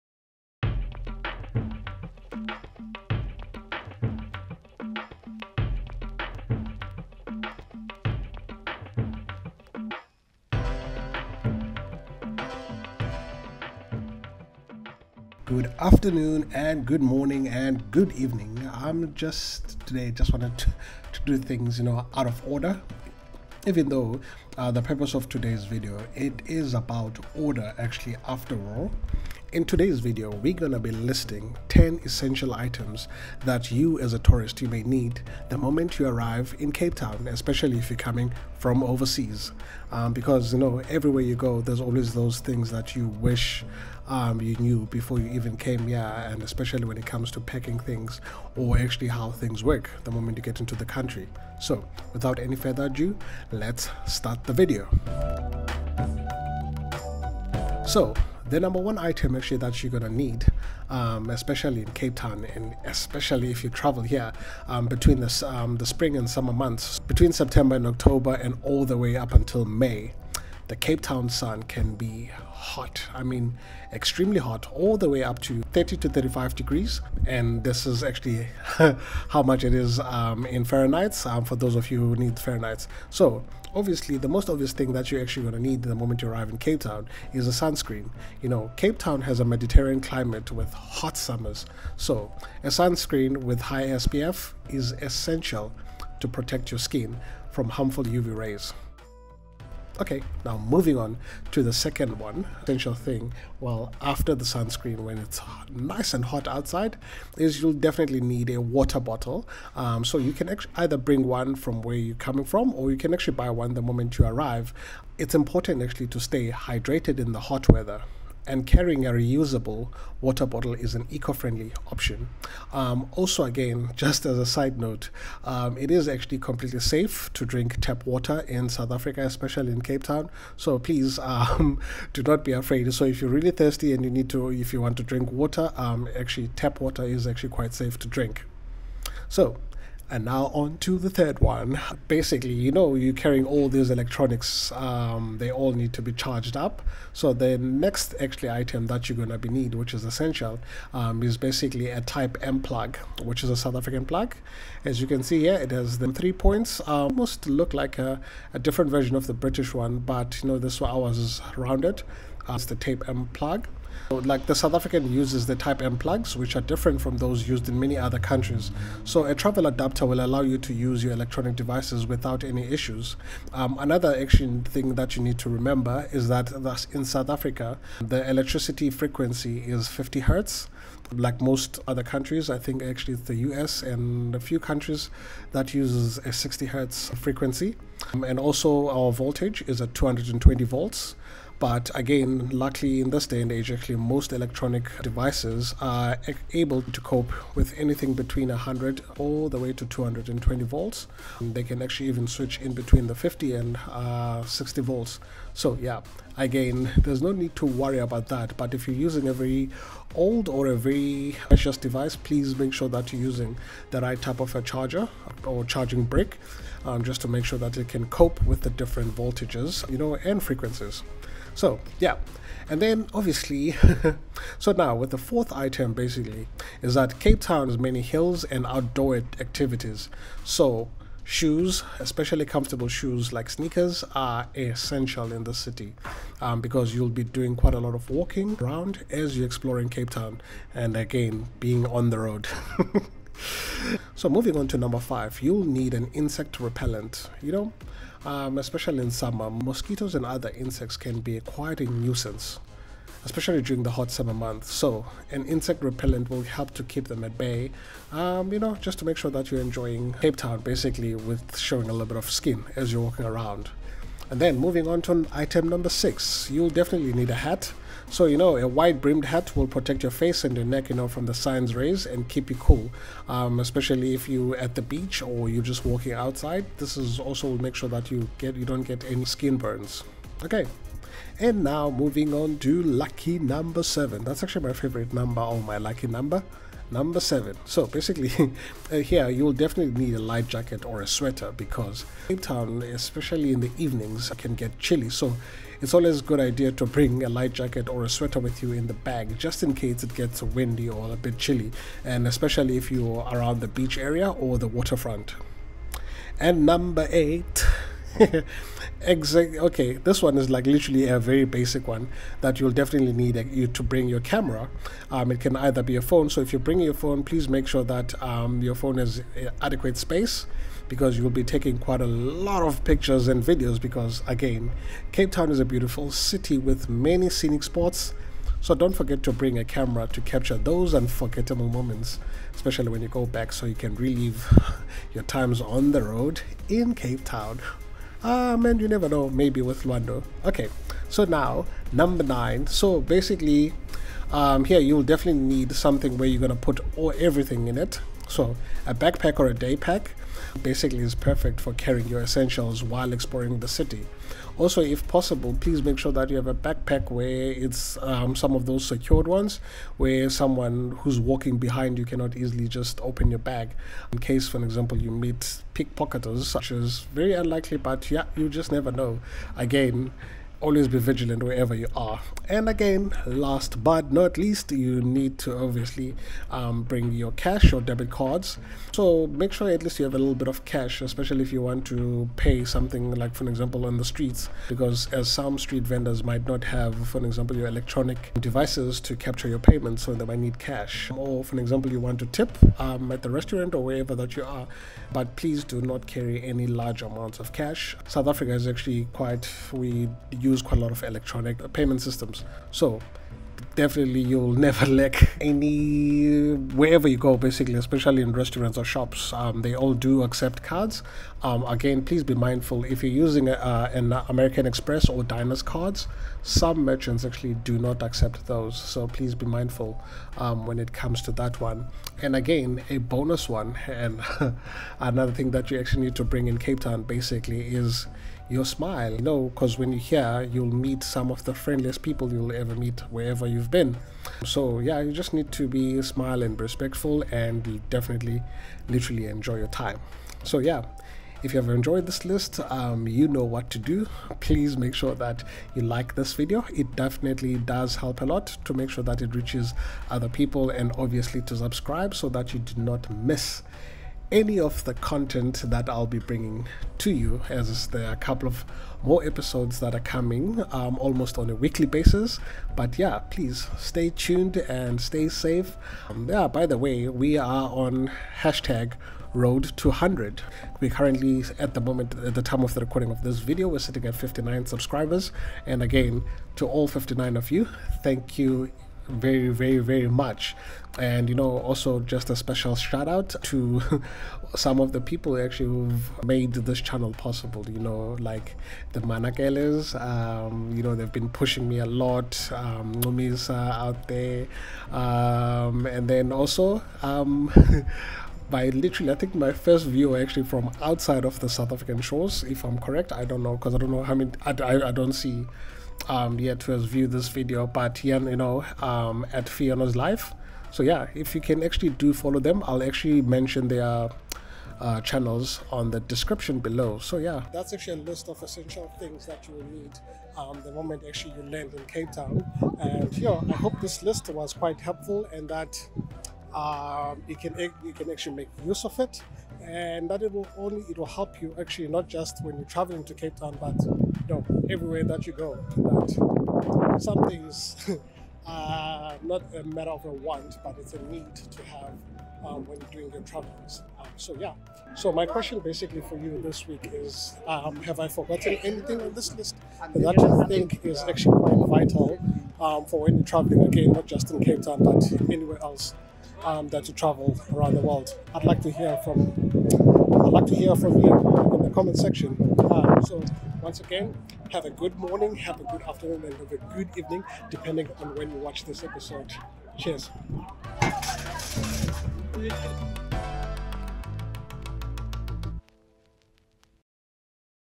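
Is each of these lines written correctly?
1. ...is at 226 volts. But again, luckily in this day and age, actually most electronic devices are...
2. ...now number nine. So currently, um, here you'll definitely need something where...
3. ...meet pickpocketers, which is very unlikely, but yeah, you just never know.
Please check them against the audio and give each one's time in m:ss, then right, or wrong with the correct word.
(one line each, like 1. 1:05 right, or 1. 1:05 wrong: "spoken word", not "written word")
1. 3:09 wrong: "220", not "226"
2. 5:41 wrong: "basically", not "currently"
3. 6:05 right.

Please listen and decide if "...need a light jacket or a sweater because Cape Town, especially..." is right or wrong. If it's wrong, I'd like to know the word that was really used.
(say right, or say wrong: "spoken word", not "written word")
right.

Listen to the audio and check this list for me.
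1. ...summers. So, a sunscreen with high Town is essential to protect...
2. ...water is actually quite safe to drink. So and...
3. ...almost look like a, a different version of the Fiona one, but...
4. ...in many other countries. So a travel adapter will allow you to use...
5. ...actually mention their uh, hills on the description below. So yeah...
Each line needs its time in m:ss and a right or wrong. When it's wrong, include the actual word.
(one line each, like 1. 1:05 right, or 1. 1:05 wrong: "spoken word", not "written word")
1. 1:31 wrong: "SPF", not "Town"
2. 2:16 right
3. 2:37 wrong: "British", not "Fiona"
4. 2:47 right
5. 8:32 wrong: "channels", not "hills".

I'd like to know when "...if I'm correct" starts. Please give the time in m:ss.
8:22.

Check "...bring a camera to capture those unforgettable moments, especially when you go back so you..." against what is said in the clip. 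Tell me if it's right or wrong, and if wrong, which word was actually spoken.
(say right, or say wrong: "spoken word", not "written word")
right.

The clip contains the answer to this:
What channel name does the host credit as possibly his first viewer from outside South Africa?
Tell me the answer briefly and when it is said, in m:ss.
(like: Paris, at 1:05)
Fiona's Life, at 8:29.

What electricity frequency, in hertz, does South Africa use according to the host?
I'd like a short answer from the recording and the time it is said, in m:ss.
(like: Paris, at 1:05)
50 hertz, at 2:59.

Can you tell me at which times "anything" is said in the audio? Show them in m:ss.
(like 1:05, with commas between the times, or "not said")
3:17, 9:08.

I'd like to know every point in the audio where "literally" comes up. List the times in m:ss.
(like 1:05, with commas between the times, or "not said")
5:10, 7:18, 8:18.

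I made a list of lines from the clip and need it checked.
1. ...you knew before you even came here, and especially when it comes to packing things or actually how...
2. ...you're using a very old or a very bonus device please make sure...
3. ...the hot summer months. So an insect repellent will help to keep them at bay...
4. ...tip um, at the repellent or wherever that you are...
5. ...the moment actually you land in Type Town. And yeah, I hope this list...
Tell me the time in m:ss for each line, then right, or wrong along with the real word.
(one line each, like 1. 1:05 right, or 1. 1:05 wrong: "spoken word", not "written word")
1. 0:44 right
2. 3:28 wrong: "precious", not "bonus"
3. 4:13 right
4. 6:32 wrong: "restaurant", not "repellent"
5. 8:40 wrong: "Cape", not "Type".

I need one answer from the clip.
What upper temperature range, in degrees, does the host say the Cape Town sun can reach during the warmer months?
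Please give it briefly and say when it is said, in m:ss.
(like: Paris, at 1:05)
30 to 35 degrees, at 1:15.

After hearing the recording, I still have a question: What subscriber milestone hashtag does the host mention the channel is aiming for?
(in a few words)
road 200.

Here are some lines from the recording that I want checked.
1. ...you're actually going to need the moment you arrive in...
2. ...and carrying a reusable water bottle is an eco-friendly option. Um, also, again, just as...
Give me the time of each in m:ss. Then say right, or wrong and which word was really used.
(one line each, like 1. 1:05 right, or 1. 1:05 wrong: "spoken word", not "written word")
1. 1:25 right
2. 1:58 right.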